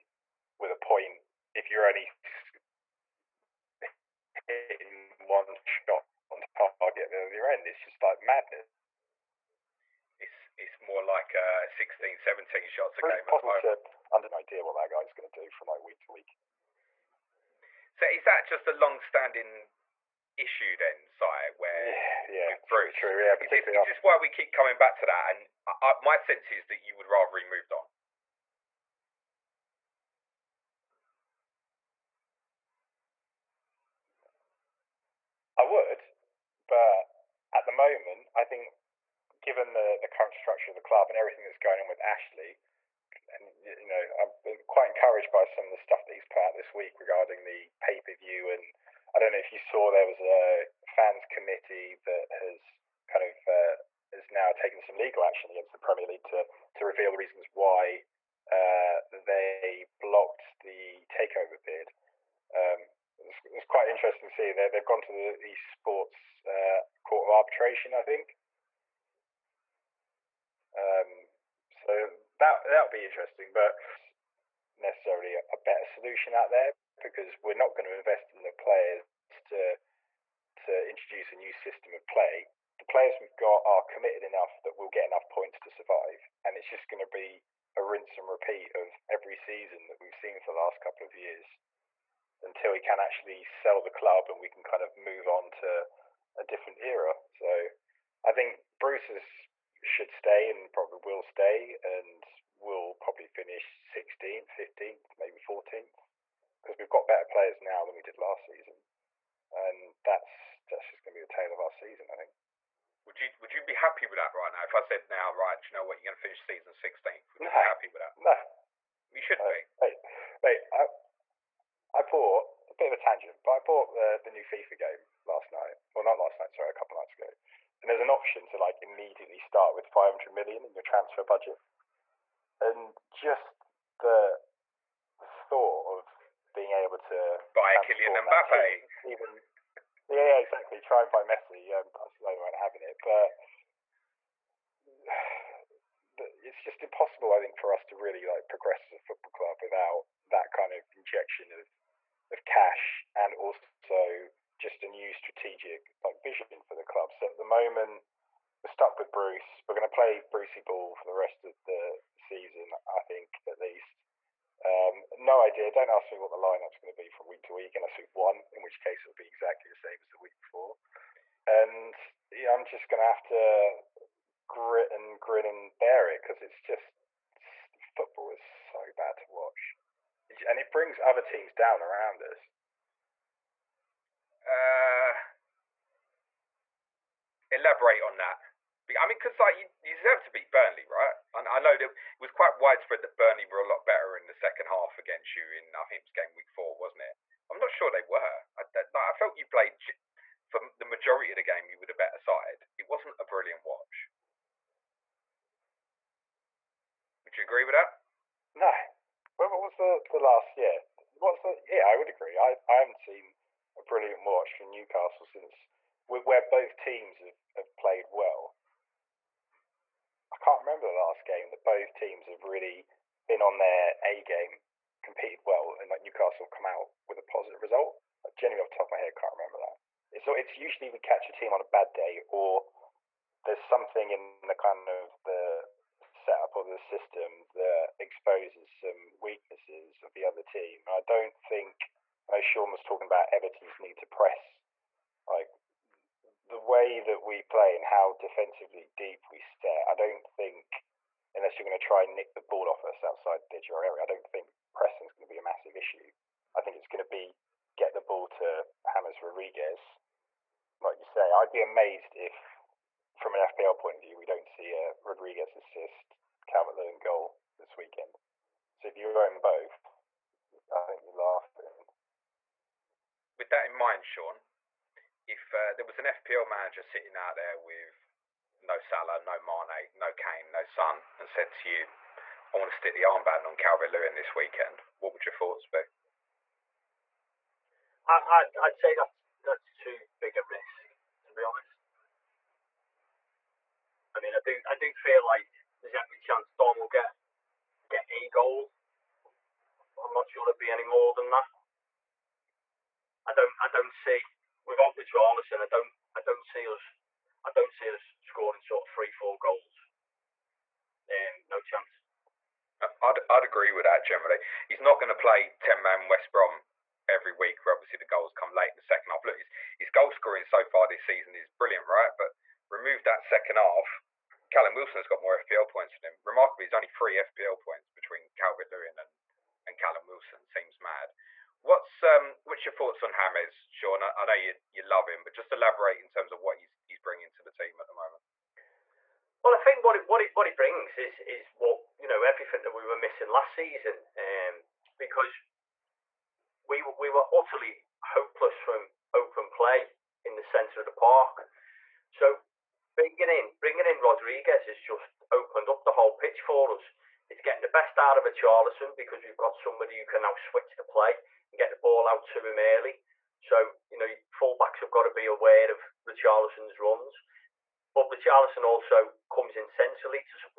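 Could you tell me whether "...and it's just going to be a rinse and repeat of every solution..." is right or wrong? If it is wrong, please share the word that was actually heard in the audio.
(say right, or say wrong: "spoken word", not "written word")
wrong: "season", not "solution".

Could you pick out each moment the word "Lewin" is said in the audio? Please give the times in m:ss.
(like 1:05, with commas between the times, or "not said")
4:26, 4:43, 5:28.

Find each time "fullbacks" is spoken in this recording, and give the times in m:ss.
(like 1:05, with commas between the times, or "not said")
6:04.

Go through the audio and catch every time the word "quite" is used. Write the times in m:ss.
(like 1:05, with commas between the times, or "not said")
0:44, 1:03, 3:12.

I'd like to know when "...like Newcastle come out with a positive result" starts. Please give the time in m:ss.
3:45.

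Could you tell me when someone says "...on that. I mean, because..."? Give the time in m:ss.
3:08.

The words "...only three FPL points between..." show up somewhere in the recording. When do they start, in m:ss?
5:26.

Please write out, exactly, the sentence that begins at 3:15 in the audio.
In I think it was game week four, wasn't it?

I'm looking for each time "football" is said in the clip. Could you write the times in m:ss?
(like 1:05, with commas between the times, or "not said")
2:29, 2:57.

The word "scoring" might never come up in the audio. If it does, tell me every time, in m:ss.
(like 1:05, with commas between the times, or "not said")
5:08, 5:20.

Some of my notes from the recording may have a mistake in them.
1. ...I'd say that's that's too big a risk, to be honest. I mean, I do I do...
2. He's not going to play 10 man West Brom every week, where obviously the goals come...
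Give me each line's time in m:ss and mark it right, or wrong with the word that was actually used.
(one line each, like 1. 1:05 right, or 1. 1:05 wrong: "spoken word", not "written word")
1. 4:48 right
2. 5:14 right.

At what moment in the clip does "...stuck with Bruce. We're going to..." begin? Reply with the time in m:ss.
2:38.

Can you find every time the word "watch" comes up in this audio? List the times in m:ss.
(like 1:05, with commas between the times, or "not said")
2:59, 3:23, 3:34.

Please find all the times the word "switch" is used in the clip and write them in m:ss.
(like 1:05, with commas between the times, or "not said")
6:00.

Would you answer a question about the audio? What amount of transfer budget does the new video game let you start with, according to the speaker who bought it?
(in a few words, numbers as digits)
500 million.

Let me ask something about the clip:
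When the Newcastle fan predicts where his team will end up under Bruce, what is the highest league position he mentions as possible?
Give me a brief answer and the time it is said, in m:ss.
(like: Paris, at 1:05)
14th, at 1:45.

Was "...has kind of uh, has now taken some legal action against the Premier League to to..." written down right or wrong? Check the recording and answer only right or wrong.
right.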